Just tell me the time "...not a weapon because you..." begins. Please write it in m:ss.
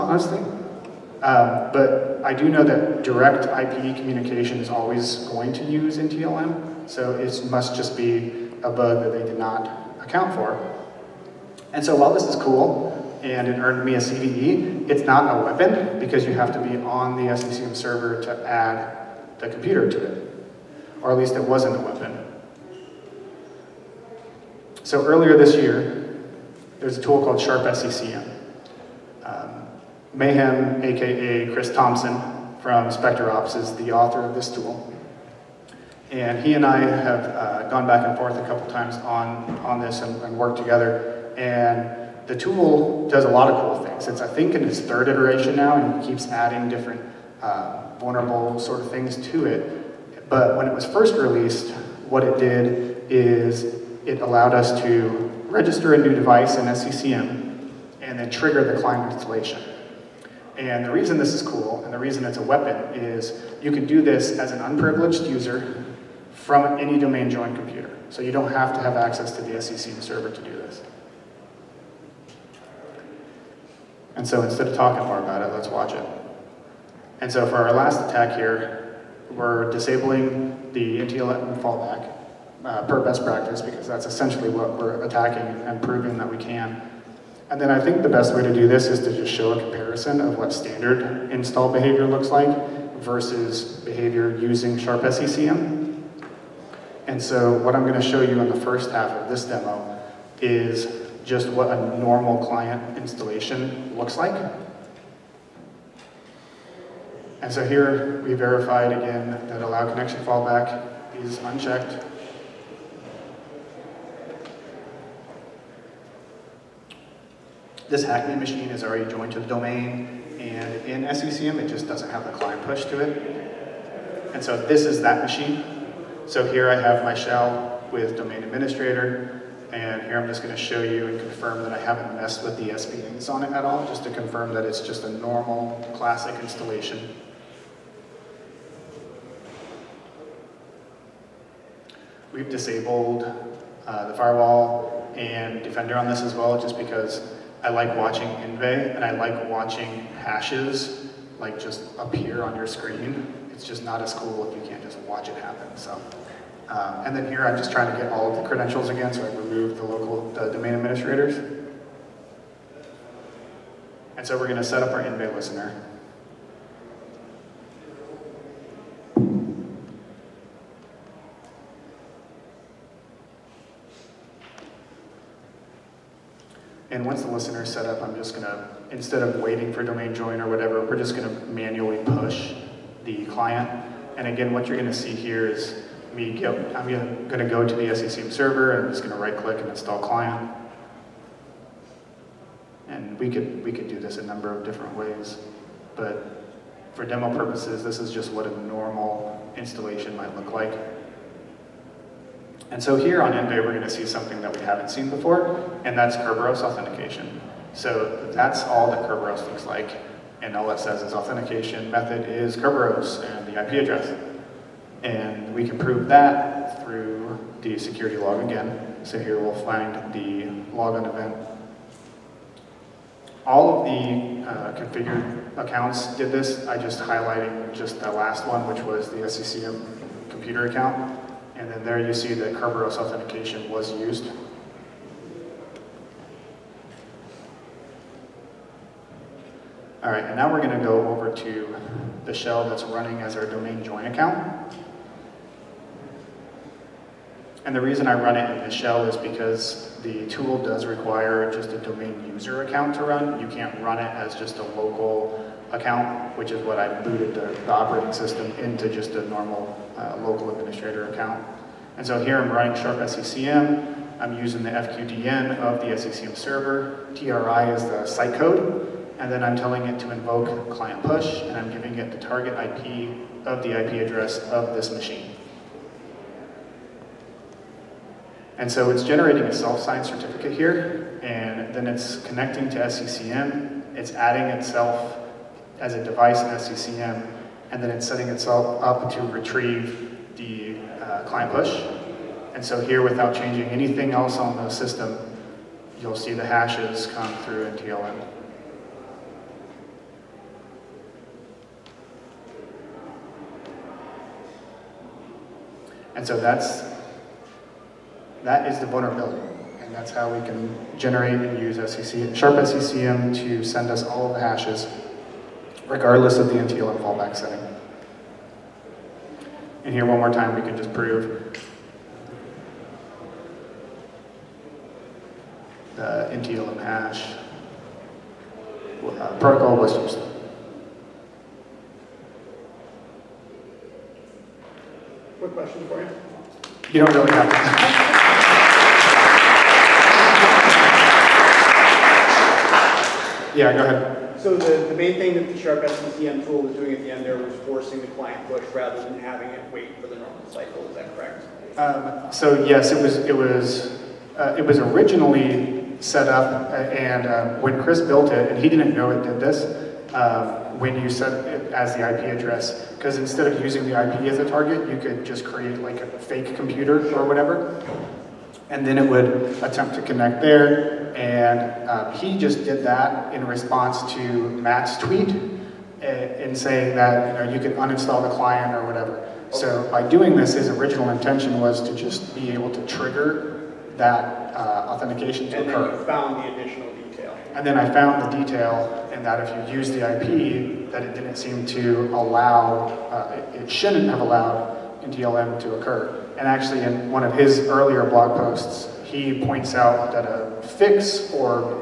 0:15.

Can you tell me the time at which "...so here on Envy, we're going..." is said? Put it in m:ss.
3:22.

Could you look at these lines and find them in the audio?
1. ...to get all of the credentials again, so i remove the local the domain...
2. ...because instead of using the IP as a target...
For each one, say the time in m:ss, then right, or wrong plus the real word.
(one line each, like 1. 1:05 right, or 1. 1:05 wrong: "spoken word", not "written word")
1. 2:37 right
2. 6:02 right.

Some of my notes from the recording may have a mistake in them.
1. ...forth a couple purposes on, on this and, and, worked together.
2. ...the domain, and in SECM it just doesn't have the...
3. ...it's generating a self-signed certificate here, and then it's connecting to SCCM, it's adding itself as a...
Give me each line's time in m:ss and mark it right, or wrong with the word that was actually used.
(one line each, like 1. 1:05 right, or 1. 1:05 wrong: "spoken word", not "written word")
1. 0:38 wrong: "times", not "purposes"
2. 1:59 right
3. 4:38 right.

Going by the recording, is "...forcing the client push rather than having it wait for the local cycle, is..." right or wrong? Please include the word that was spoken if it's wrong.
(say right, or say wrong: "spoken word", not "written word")
wrong: "normal", not "local".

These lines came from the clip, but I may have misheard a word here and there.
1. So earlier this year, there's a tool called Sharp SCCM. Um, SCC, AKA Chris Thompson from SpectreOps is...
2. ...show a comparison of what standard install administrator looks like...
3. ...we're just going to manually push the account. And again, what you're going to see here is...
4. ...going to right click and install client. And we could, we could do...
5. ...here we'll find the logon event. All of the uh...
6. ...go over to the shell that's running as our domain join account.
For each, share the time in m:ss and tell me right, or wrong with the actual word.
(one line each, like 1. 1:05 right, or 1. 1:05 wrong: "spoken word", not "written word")
1. 0:24 wrong: "Mayhem", not "SCC"
2. 1:29 wrong: "behavior", not "administrator"
3. 3:00 wrong: "client", not "account"
4. 3:09 right
5. 3:39 right
6. 4:00 right.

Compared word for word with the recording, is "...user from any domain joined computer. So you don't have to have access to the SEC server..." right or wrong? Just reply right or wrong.
right.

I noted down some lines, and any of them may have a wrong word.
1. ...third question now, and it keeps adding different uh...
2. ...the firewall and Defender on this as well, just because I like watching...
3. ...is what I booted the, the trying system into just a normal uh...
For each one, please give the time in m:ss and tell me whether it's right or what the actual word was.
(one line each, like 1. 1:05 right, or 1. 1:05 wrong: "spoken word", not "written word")
1. 0:44 wrong: "iteration", not "question"
2. 2:24 right
3. 4:16 wrong: "operating", not "trying".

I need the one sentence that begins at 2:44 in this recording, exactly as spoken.
And so we're going to set up our invade listener.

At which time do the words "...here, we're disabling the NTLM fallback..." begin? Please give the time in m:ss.
1:18.